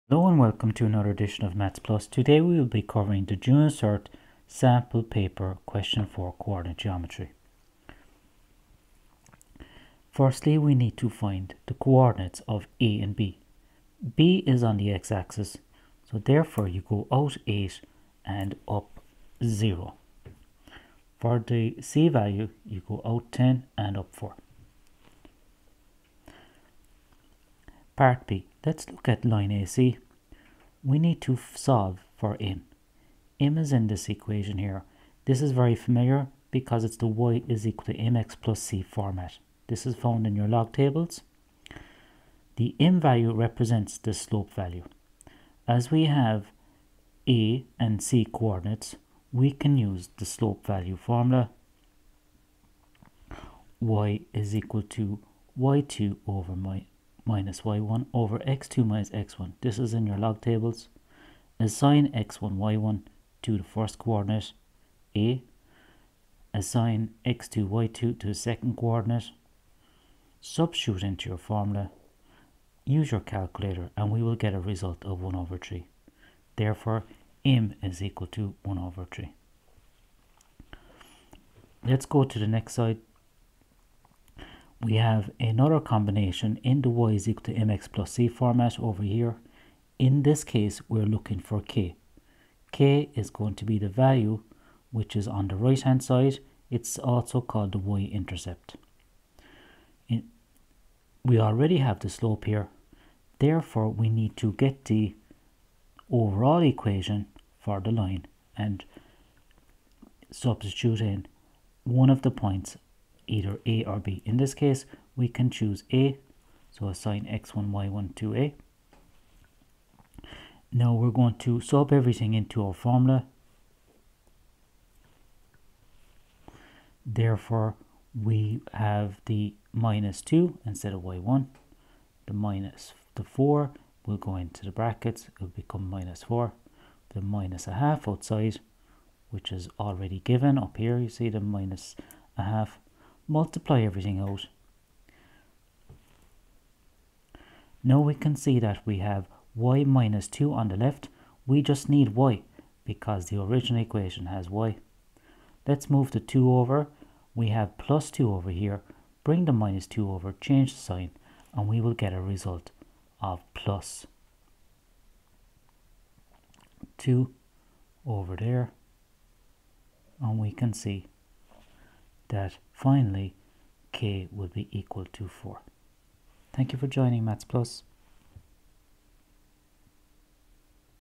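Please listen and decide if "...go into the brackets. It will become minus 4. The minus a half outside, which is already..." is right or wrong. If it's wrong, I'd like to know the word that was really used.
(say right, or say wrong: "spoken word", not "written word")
right.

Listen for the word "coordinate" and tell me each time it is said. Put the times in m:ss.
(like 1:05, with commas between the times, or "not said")
0:06, 0:11, 0:48, 1:03, 1:08.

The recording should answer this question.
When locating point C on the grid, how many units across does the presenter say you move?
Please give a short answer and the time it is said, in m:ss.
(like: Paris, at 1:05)
10, at 0:23.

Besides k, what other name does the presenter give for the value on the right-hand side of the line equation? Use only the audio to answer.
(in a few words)
y-intercept.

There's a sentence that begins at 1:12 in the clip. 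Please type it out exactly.
Use your calculator and we will get a result of 1 over 3.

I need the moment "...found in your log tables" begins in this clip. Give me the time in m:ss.
0:39.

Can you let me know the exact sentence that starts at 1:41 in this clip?
We already have the slope here.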